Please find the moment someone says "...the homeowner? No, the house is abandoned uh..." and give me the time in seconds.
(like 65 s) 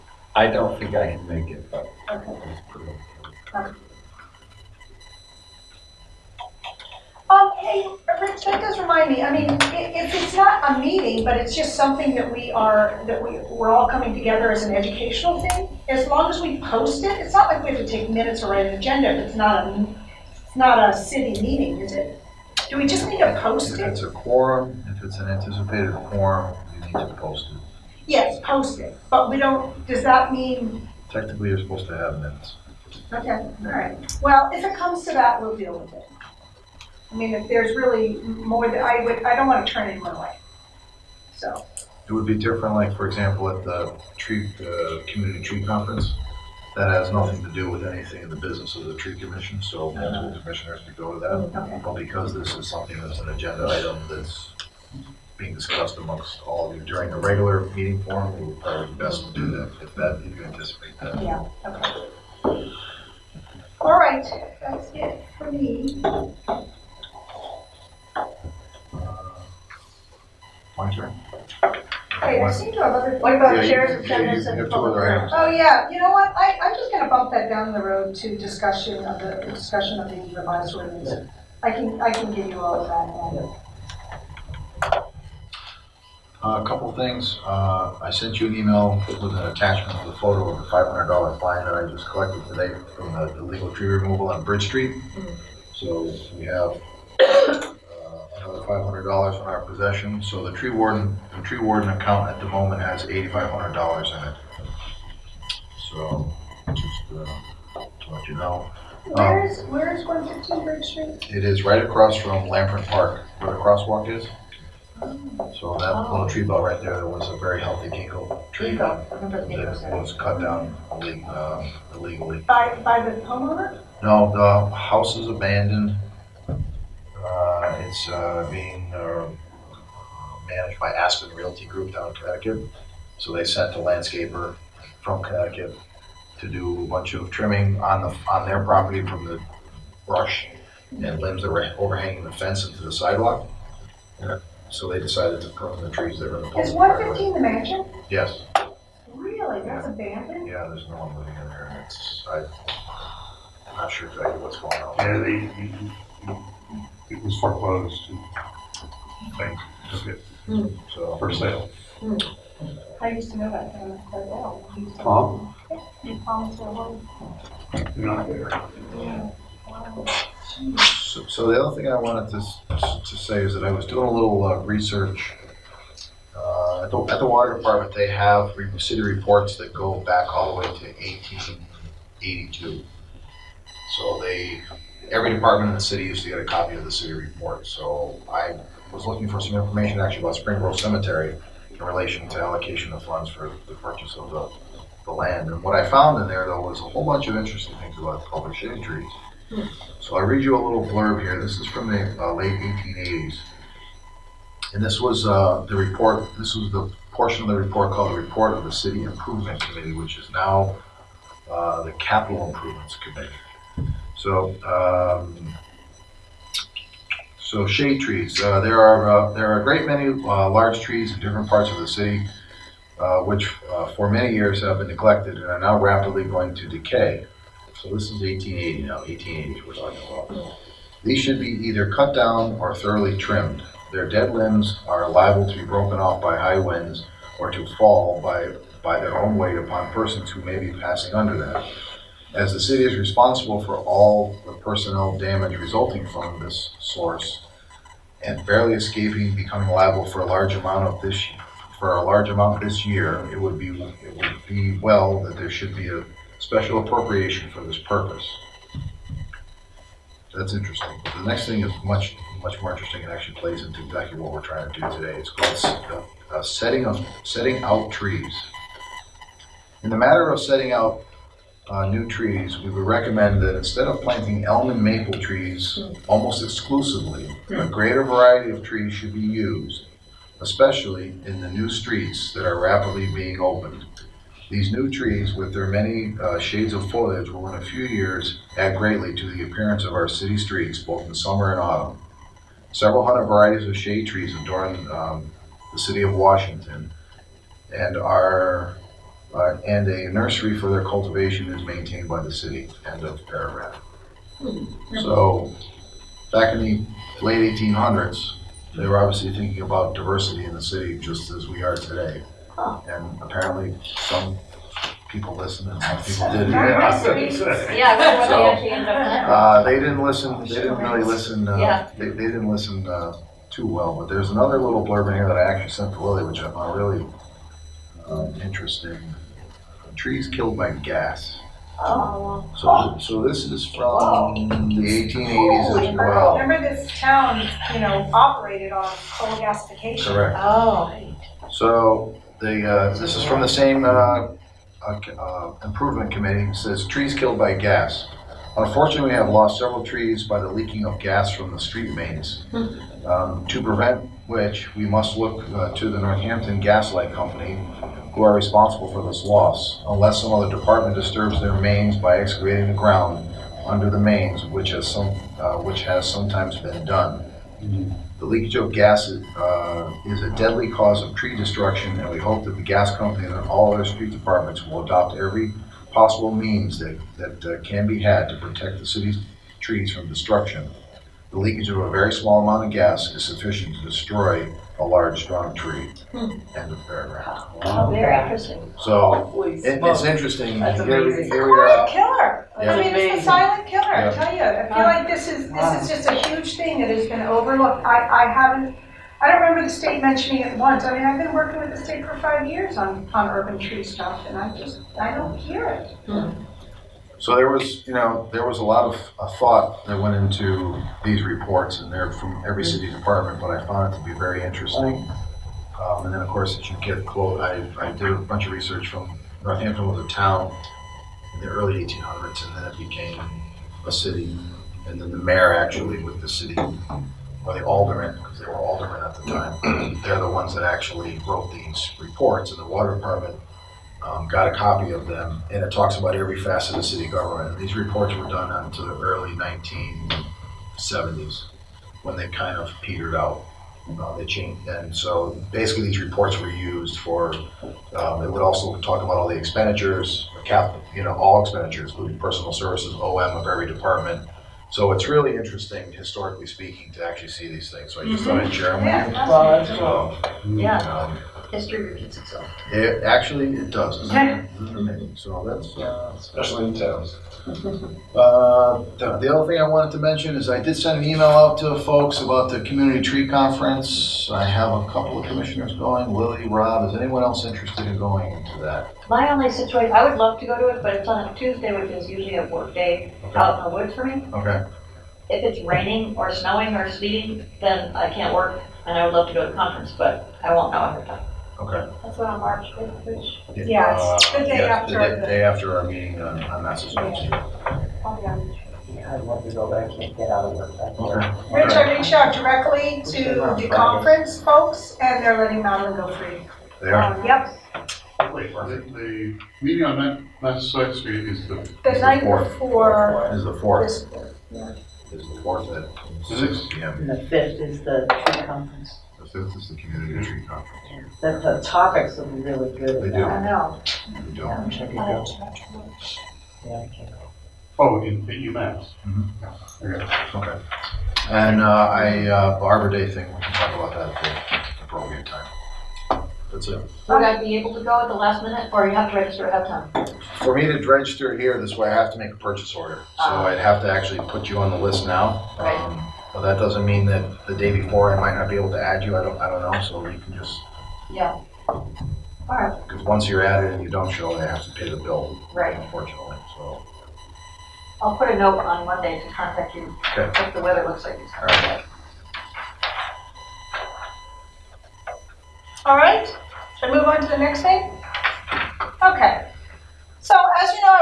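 123 s.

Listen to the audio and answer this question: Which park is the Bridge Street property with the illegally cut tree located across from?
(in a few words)
Lampron Park.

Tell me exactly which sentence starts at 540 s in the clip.
For me to register here this way, I have to make a purchase order.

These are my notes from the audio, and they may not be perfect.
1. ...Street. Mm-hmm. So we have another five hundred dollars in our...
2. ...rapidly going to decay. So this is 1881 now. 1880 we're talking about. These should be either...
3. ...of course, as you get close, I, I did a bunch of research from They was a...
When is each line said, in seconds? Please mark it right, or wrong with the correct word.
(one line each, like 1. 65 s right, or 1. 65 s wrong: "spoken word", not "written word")
1. 94 s right
2. 225 s wrong: "1880", not "1881"
3. 416 s wrong: "Northampton", not "They".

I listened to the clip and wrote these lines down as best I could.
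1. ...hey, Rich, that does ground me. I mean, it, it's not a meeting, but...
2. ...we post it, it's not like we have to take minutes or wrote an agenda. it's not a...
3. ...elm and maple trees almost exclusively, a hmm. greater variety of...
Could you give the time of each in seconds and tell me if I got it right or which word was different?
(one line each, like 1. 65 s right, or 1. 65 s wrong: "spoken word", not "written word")
1. 7 s wrong: "remind", not "ground"
2. 16 s wrong: "write", not "wrote"
3. 274 s right.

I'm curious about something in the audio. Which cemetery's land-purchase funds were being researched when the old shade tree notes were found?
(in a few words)
Spring Grove Cemetery.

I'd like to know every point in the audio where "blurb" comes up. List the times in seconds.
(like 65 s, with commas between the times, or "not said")
200 s, 324 s.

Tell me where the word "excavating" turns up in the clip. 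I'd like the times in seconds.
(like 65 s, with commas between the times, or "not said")
362 s.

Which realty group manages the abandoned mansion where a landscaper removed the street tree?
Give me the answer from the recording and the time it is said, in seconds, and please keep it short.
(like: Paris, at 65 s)
Aspen Realty Group, at 130 s.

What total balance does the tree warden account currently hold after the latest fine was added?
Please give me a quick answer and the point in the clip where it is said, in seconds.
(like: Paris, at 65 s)
$8,500, at 103 s.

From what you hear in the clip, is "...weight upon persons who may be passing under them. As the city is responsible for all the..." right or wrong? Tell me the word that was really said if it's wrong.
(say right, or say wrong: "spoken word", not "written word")
right.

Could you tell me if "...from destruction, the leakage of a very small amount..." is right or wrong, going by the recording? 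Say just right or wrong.
right.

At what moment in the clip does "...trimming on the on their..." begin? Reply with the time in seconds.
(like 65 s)
137 s.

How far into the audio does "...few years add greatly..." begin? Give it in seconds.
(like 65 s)
287 s.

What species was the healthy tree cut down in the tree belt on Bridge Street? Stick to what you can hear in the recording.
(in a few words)
Ginkgo.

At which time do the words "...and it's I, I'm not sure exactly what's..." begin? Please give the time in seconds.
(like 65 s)
151 s.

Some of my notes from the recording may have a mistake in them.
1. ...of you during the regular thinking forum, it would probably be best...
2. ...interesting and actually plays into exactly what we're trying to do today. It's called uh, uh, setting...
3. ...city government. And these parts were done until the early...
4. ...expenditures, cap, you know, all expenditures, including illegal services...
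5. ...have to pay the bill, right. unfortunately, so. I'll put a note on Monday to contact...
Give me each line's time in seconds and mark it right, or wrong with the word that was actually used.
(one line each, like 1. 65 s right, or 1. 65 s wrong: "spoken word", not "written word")
1. 56 s wrong: "meeting", not "thinking"
2. 262 s right
3. 436 s wrong: "reports", not "parts"
4. 449 s wrong: "personal", not "illegal"
5. 554 s right.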